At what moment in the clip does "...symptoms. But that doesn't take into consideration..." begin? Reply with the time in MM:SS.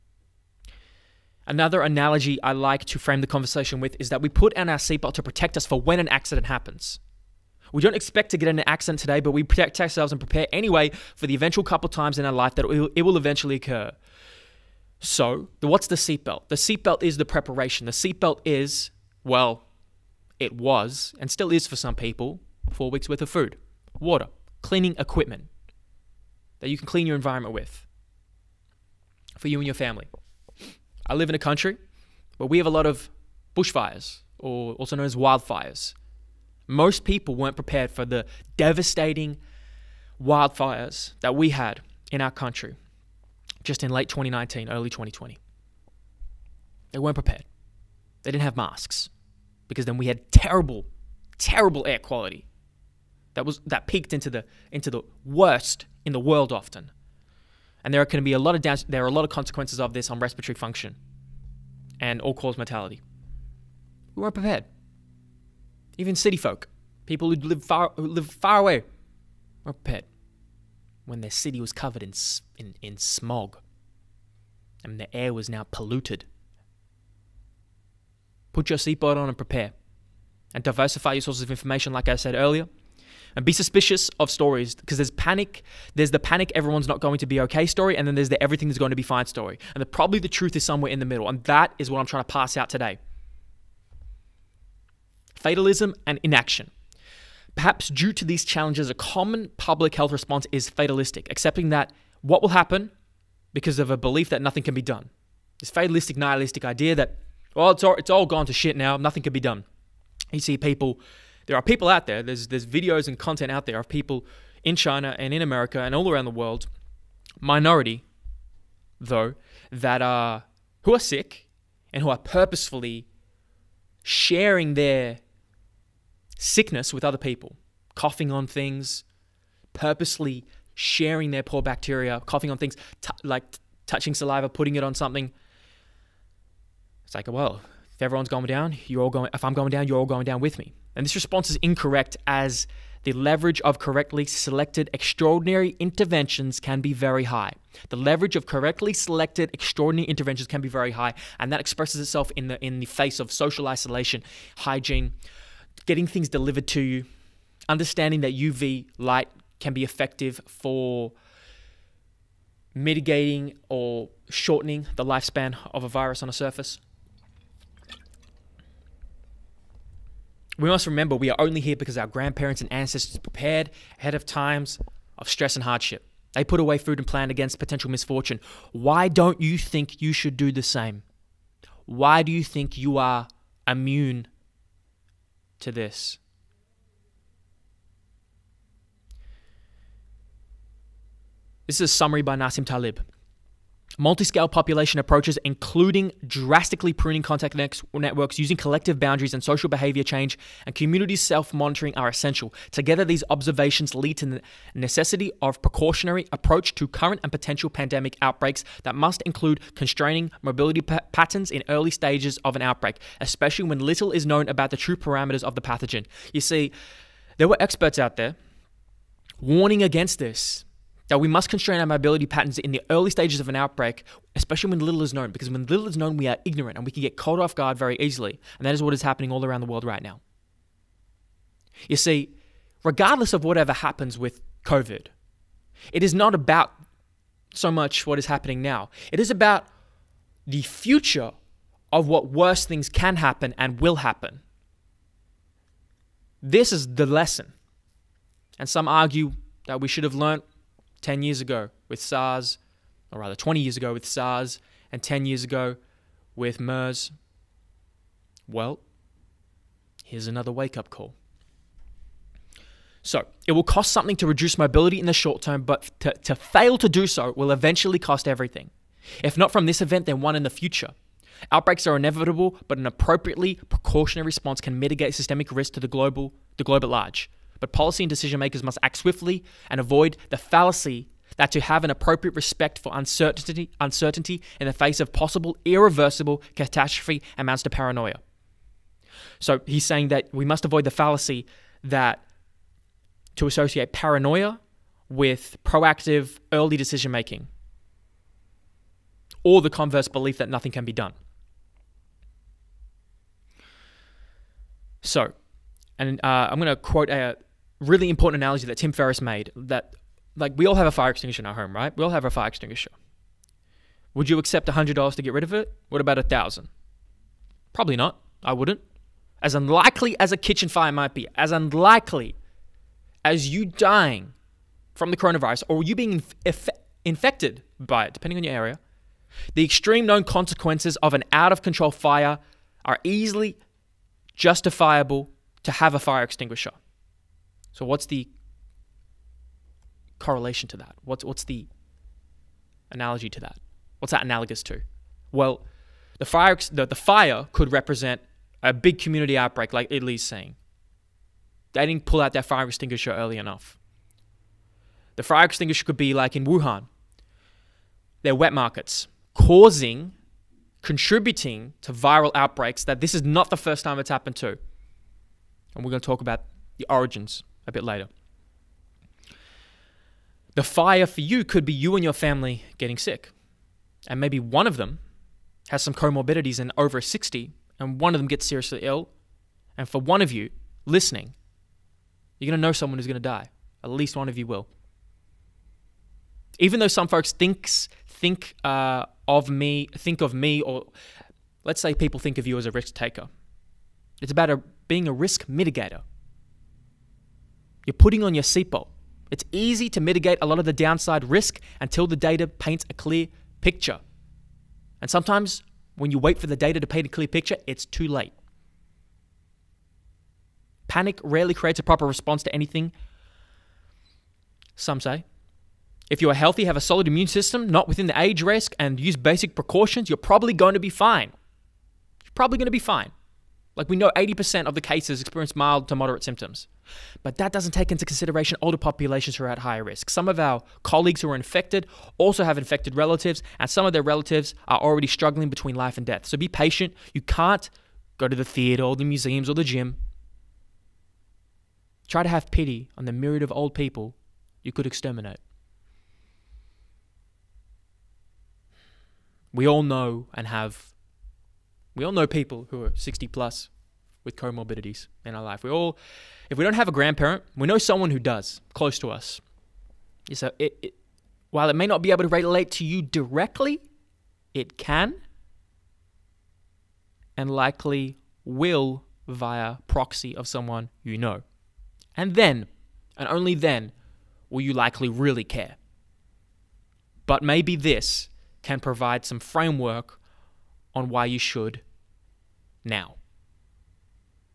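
07:06.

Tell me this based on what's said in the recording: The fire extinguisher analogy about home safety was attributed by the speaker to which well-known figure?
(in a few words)
Tim Ferriss.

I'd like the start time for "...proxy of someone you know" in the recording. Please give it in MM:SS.
07:49.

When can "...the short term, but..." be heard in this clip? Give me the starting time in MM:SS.
04:25.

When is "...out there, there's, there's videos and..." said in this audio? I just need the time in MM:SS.
01:51.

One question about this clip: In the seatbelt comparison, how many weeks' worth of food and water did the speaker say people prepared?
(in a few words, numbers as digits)
4.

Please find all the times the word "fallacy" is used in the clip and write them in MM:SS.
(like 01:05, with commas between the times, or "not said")
04:40, 04:50.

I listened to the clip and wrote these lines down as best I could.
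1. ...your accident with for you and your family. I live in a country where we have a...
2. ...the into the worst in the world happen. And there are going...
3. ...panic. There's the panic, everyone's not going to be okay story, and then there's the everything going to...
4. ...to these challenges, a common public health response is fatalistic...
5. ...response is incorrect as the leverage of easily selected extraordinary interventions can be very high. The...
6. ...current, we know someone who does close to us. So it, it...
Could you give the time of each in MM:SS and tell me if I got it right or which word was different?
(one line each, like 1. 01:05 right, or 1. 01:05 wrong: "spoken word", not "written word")
1. 00:27 wrong: "environment", not "accident"
2. 00:54 wrong: "often", not "happen"
3. 01:25 right
4. 01:38 right
5. 02:21 wrong: "correctly", not "easily"
6. 07:36 wrong: "grandparent", not "current".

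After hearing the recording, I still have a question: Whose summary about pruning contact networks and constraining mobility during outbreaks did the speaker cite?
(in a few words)
Nassim Taleb.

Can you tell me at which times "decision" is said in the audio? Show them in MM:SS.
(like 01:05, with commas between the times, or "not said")
04:38, 04:56.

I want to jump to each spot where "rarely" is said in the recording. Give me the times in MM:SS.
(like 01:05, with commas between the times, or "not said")
06:51.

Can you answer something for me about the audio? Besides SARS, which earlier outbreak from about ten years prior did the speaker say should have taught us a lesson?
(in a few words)
MERS.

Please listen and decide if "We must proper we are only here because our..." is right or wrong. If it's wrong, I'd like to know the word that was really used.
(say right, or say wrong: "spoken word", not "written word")
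wrong: "remember", not "proper".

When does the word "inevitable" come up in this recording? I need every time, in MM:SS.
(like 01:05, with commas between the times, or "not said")
04:31.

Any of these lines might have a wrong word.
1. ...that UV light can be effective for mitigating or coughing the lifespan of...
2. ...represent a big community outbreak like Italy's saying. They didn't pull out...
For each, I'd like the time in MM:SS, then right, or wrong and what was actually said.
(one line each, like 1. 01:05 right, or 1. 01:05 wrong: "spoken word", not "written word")
1. 02:38 wrong: "shortening", not "coughing"
2. 05:47 right.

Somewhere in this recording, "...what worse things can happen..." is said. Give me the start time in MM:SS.
04:02.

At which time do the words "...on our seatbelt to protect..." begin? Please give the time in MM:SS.
00:04.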